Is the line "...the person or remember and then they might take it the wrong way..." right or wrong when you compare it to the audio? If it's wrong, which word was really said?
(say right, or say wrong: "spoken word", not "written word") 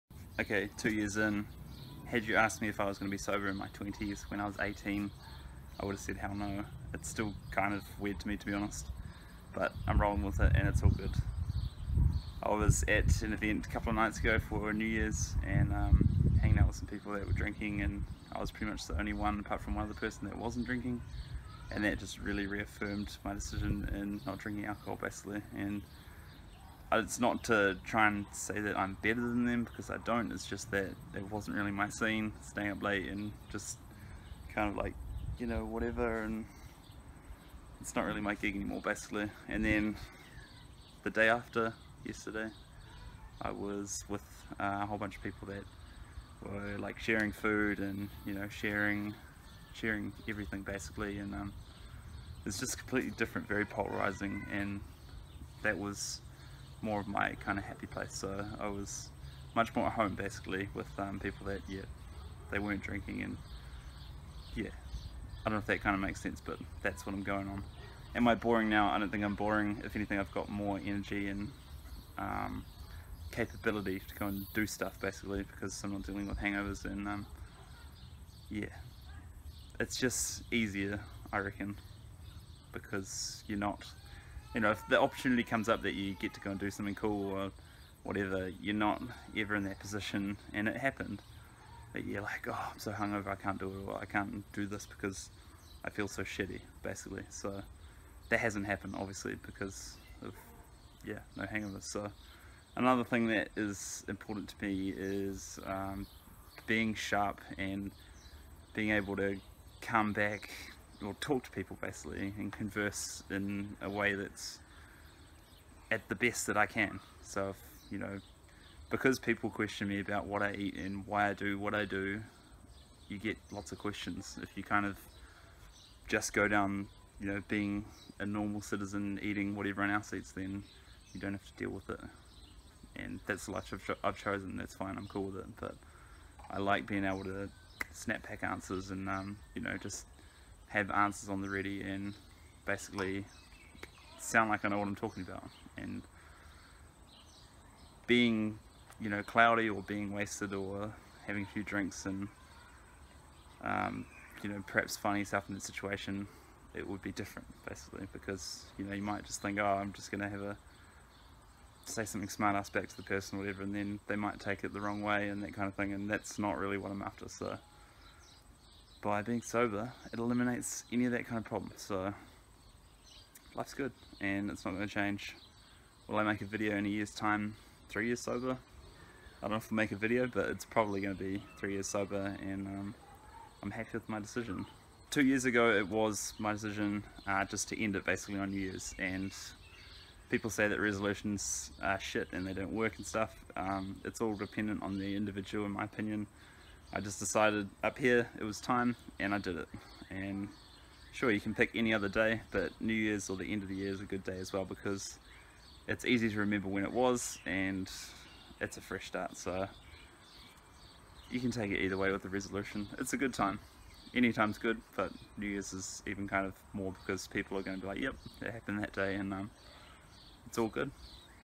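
wrong: "whatever", not "remember".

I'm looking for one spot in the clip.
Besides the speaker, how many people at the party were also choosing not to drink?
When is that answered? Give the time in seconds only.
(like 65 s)
19 s.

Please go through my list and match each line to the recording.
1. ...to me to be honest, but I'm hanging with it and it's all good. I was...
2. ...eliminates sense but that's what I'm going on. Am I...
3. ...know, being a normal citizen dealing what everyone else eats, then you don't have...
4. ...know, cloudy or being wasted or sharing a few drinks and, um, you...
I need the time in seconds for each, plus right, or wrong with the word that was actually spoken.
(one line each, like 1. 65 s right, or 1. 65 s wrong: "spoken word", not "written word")
1. 8 s wrong: "rolling", not "hanging"
2. 65 s wrong: "makes", not "eliminates"
3. 127 s wrong: "eating", not "dealing"
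4. 149 s wrong: "having", not "sharing".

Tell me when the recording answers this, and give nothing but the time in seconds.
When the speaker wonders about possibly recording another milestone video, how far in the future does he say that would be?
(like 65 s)
176 s.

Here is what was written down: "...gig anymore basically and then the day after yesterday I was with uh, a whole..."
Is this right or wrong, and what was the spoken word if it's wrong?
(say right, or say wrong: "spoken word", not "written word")
right.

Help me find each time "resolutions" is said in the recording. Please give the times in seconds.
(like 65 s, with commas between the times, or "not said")
190 s, 212 s.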